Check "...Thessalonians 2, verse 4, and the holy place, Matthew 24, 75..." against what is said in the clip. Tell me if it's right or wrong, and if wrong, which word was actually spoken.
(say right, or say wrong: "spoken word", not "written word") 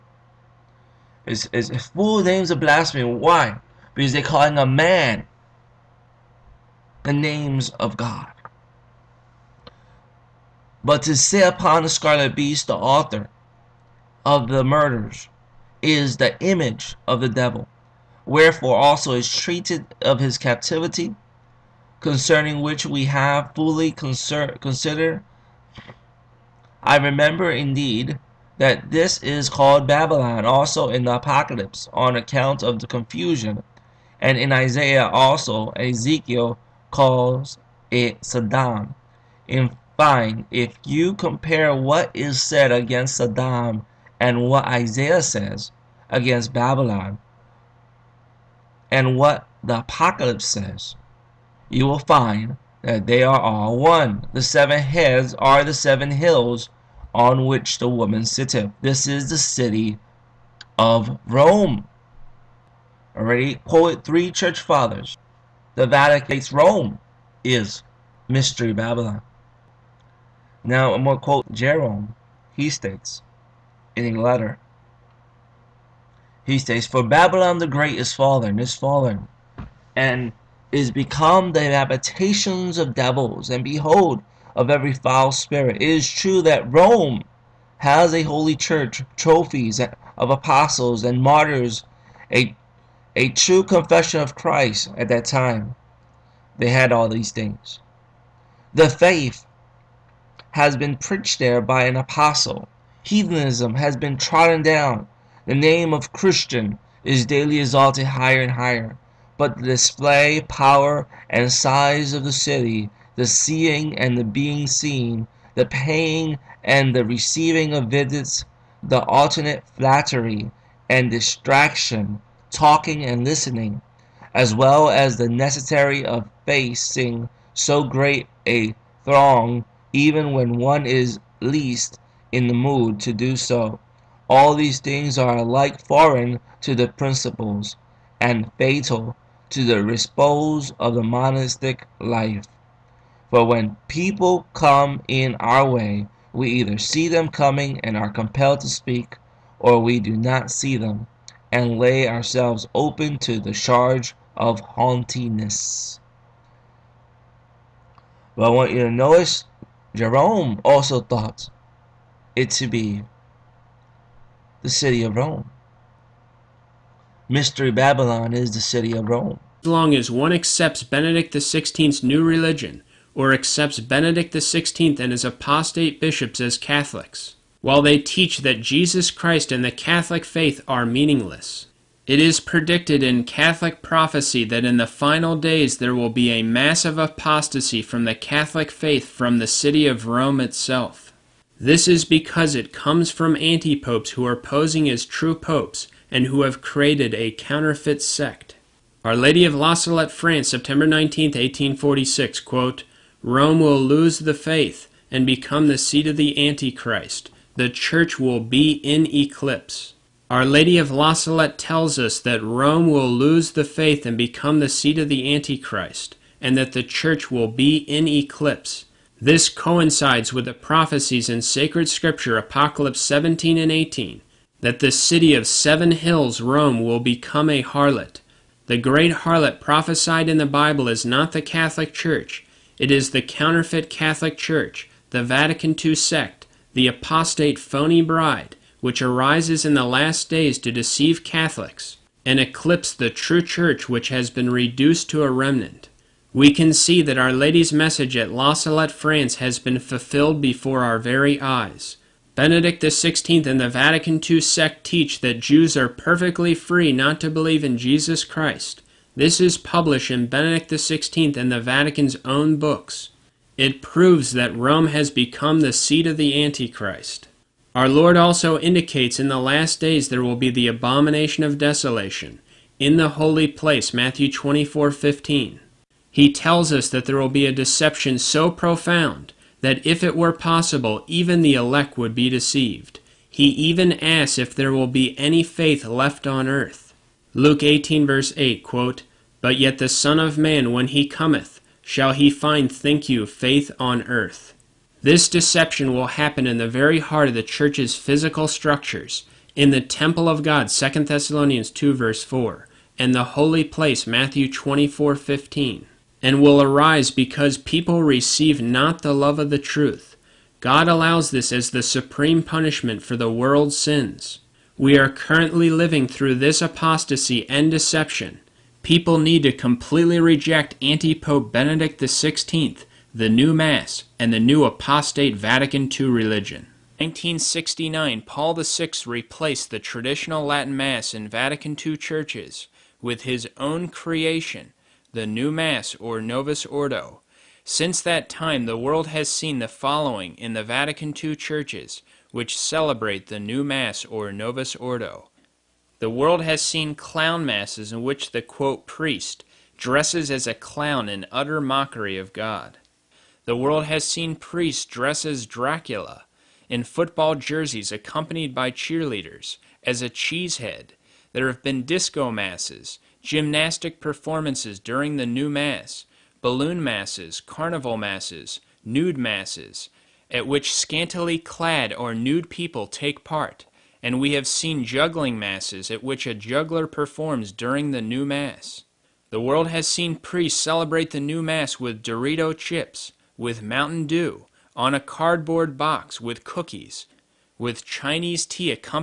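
wrong: "15", not "75".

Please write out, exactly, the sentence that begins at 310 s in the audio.
God allows this as the supreme punishment for the world's sins.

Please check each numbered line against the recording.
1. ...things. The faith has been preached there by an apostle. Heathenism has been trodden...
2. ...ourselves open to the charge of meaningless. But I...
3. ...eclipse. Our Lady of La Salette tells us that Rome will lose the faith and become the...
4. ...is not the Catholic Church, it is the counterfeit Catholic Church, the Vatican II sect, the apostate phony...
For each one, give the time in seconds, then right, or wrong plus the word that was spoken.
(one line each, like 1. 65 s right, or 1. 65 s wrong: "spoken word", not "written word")
1. 97 s right
2. 152 s wrong: "haughtiness", not "meaningless"
3. 209 s right
4. 230 s right.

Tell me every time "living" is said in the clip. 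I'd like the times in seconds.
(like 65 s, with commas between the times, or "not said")
315 s.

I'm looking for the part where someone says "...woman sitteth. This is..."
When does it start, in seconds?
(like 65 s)
57 s.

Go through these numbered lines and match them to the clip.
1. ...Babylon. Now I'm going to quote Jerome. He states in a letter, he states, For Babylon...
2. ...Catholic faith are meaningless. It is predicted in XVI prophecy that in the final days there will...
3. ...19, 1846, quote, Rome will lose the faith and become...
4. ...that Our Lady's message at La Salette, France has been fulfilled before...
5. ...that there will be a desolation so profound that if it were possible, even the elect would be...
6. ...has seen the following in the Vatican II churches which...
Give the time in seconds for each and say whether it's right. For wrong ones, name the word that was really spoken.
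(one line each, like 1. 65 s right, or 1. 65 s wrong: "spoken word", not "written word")
1. 68 s right
2. 179 s wrong: "Catholic", not "XVI"
3. 200 s right
4. 247 s right
5. 276 s wrong: "deception", not "desolation"
6. 339 s right.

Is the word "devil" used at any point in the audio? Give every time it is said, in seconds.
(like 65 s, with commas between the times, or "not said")
17 s, 82 s.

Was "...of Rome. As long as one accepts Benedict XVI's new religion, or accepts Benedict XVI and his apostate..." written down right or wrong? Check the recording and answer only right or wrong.
right.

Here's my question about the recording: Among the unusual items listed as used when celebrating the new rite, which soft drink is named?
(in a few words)
Mountain Dew.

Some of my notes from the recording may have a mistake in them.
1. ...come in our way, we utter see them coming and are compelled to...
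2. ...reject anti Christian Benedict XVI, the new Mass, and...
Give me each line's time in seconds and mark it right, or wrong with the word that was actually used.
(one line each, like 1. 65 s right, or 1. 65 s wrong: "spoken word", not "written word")
1. 144 s wrong: "either", not "utter"
2. 320 s wrong: "Pope", not "Christian".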